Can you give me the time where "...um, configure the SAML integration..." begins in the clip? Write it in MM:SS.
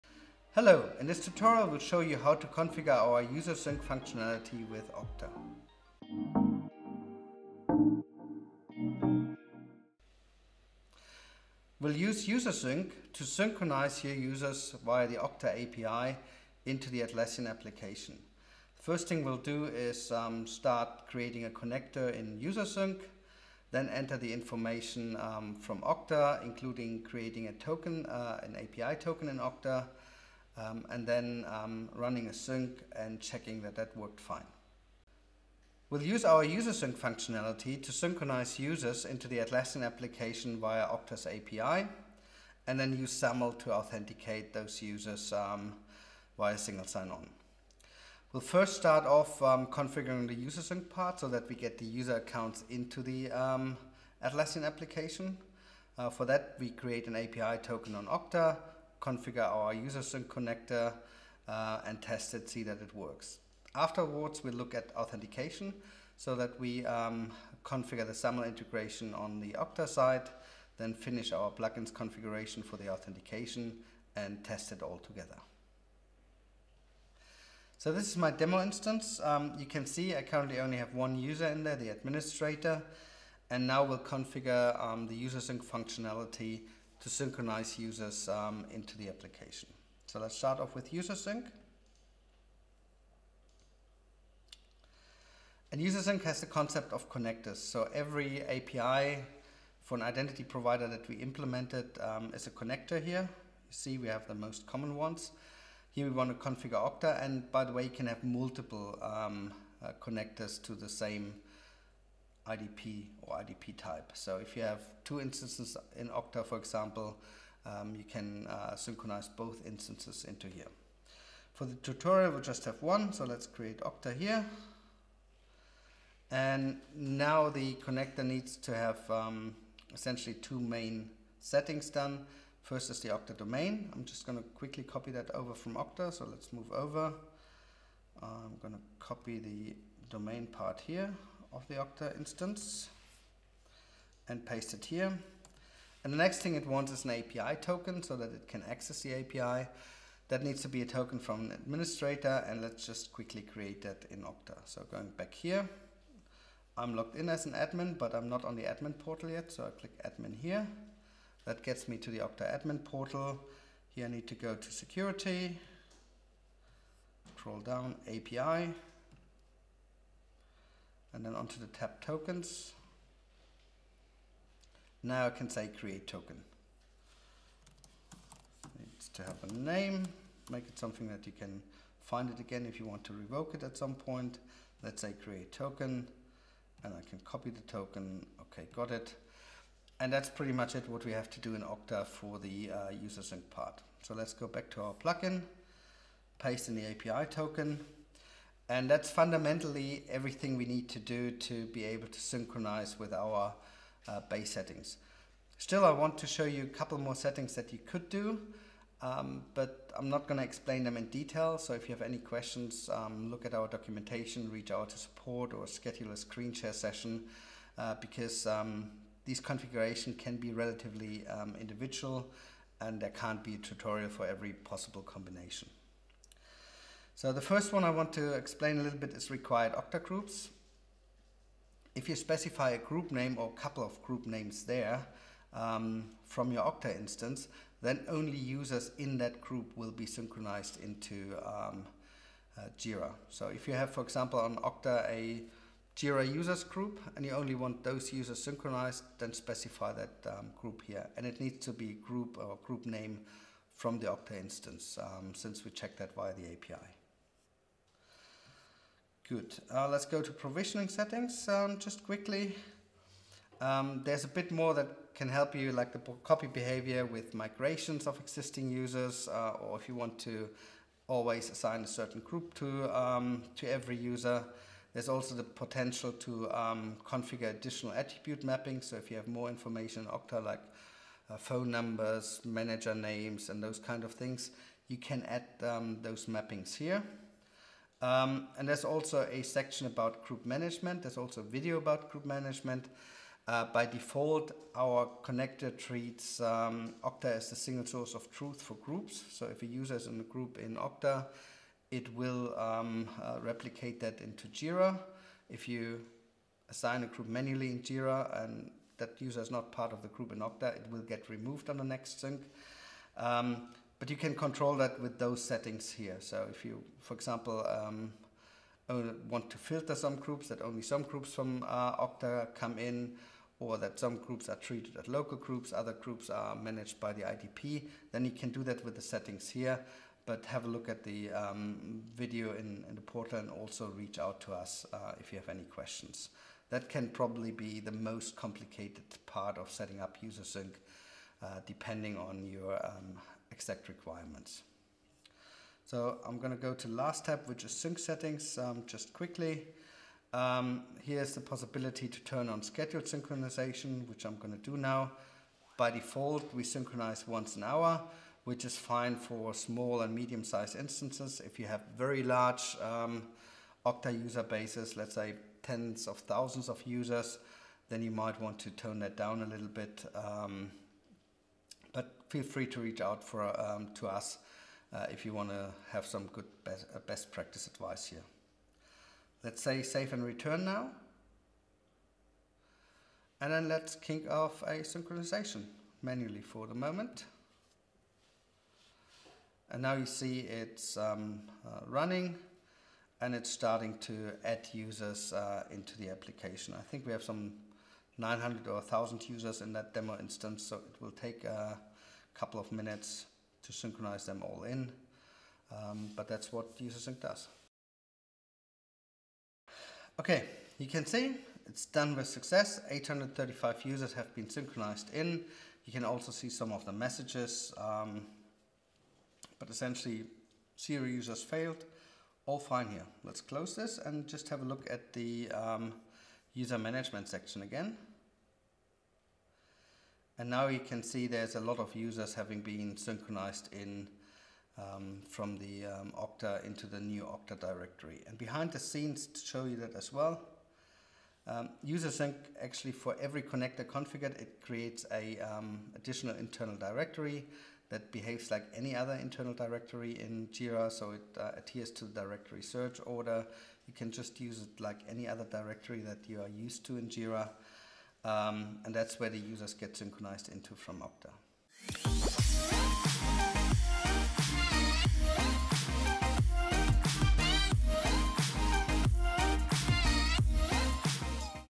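01:06.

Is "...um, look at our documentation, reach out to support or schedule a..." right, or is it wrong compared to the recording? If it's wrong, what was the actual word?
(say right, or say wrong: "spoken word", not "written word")
right.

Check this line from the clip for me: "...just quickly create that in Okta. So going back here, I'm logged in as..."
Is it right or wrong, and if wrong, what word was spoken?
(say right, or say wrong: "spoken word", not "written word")
right.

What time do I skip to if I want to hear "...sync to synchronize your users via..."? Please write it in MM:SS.
00:12.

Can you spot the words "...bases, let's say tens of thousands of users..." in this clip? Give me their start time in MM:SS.
06:04.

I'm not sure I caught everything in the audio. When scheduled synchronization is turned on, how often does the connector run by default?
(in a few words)
Once an hour.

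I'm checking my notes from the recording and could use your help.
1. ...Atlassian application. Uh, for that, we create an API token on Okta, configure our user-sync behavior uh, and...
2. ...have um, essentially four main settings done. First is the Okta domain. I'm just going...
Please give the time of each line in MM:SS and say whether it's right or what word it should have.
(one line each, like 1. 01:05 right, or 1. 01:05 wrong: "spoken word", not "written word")
1. 00:54 wrong: "connector", not "behavior"
2. 02:08 wrong: "two", not "four".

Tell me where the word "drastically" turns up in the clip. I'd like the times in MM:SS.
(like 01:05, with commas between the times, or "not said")
not said.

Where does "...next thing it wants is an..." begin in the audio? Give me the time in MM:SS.
02:26.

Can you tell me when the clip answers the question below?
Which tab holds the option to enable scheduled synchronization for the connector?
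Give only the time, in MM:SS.
05:47.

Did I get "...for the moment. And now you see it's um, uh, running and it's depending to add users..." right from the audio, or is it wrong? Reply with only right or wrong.
wrong.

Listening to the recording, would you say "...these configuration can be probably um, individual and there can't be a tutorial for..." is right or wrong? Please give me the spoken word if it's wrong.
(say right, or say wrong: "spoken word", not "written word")
wrong: "relatively", not "probably".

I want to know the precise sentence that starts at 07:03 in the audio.
Let's close this and just have a look at the um, user management section again.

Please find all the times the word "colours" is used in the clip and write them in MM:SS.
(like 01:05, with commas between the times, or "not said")
not said.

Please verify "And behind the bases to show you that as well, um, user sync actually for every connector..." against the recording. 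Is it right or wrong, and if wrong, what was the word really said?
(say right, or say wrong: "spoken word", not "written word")
wrong: "scenes", not "bases".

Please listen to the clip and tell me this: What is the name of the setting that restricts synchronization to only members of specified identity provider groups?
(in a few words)
Required Okta groups.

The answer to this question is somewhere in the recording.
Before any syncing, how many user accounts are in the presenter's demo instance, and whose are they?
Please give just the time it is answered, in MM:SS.
01:20.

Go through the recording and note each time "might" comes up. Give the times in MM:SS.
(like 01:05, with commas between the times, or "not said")
06:08.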